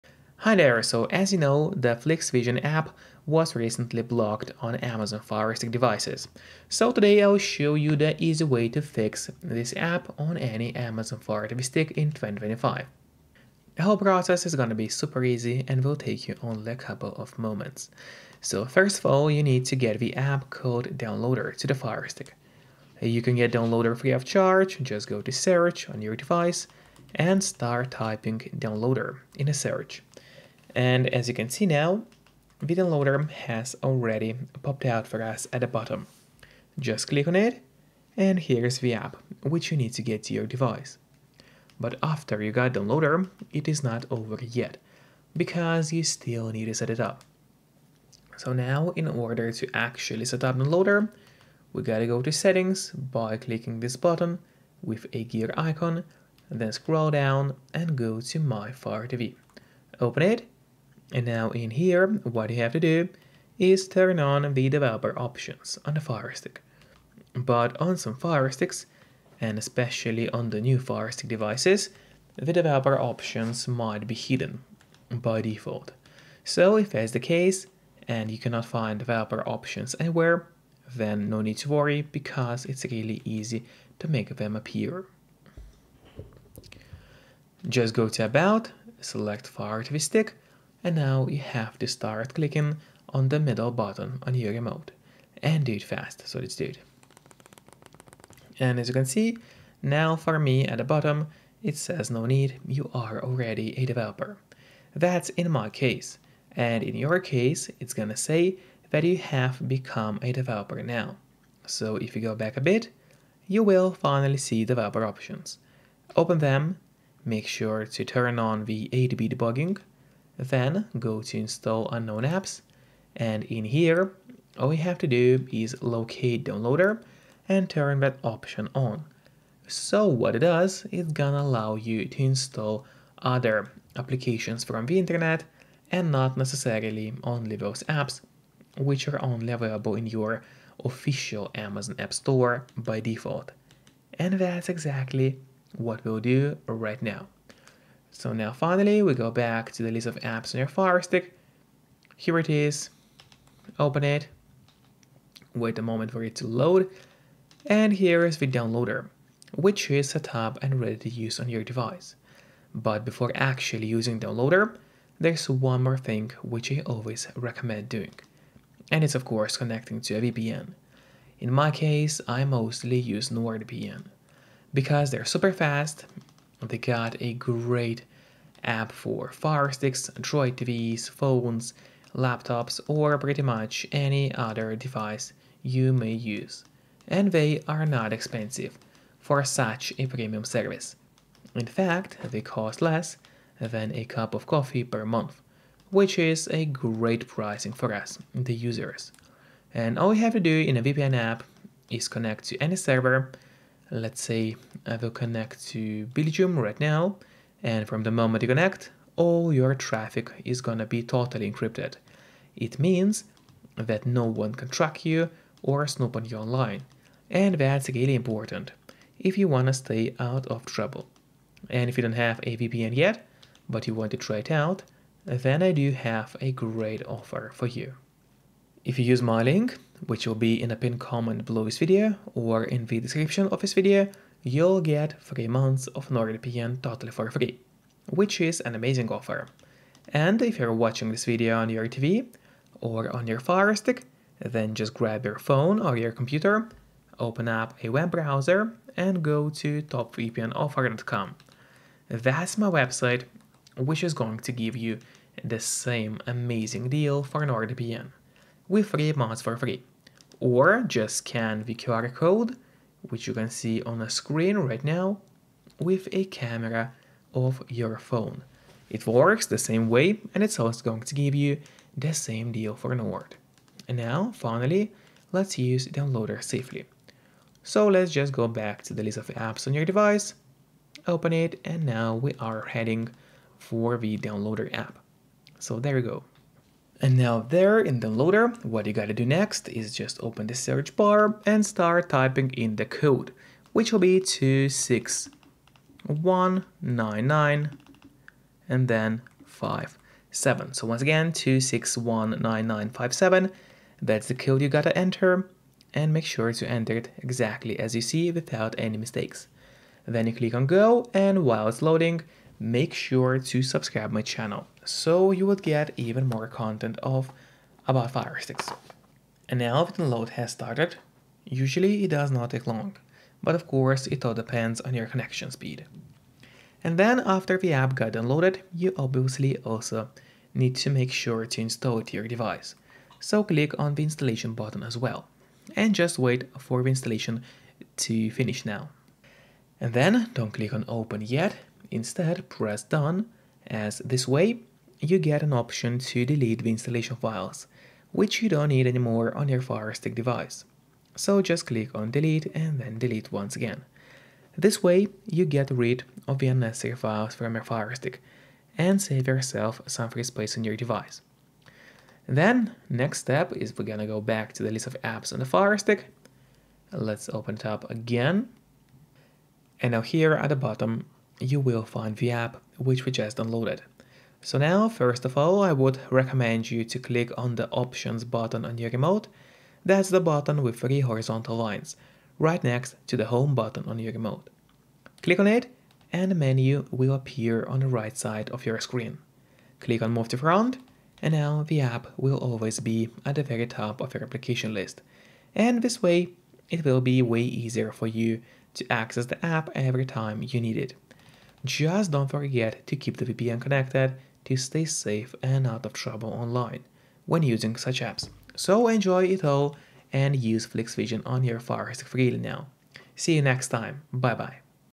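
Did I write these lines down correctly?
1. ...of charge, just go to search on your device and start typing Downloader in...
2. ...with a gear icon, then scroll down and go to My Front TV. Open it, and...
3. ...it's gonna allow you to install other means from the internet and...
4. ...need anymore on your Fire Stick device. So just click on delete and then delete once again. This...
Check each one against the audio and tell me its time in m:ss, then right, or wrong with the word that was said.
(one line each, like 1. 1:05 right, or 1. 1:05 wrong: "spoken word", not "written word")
1. 0:24 right
2. 0:54 wrong: "Fire", not "Front"
3. 2:10 wrong: "applications", not "means"
4. 5:48 right.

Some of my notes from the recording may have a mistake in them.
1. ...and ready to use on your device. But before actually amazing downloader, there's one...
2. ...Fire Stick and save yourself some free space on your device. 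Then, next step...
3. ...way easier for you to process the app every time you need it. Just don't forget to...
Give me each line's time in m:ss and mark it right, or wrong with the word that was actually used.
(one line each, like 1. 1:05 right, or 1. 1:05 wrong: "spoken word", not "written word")
1. 2:40 wrong: "using", not "amazing"
2. 5:57 right
3. 6:37 wrong: "access", not "process".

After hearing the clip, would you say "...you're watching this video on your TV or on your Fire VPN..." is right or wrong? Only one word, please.
wrong.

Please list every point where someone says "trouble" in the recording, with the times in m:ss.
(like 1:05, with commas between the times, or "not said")
3:40, 6:45.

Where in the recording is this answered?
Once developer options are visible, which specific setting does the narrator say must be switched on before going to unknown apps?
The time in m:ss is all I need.
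1:58.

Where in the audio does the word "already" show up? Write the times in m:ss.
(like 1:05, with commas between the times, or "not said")
0:33, 1:43.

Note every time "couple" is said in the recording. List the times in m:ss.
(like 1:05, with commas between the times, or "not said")
0:16.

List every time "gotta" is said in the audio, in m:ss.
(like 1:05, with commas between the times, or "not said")
0:51, 4:48, 5:04.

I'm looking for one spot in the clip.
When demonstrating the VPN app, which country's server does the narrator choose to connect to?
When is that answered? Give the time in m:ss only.
3:26.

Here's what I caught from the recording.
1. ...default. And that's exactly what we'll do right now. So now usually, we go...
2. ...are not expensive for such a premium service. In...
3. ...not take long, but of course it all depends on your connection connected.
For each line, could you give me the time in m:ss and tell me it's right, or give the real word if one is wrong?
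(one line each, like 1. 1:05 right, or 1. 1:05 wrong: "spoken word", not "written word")
1. 2:22 wrong: "finally", not "usually"
2. 3:07 right
3. 5:22 wrong: "speed", not "connected".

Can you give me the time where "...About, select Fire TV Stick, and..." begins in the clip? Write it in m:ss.
1:28.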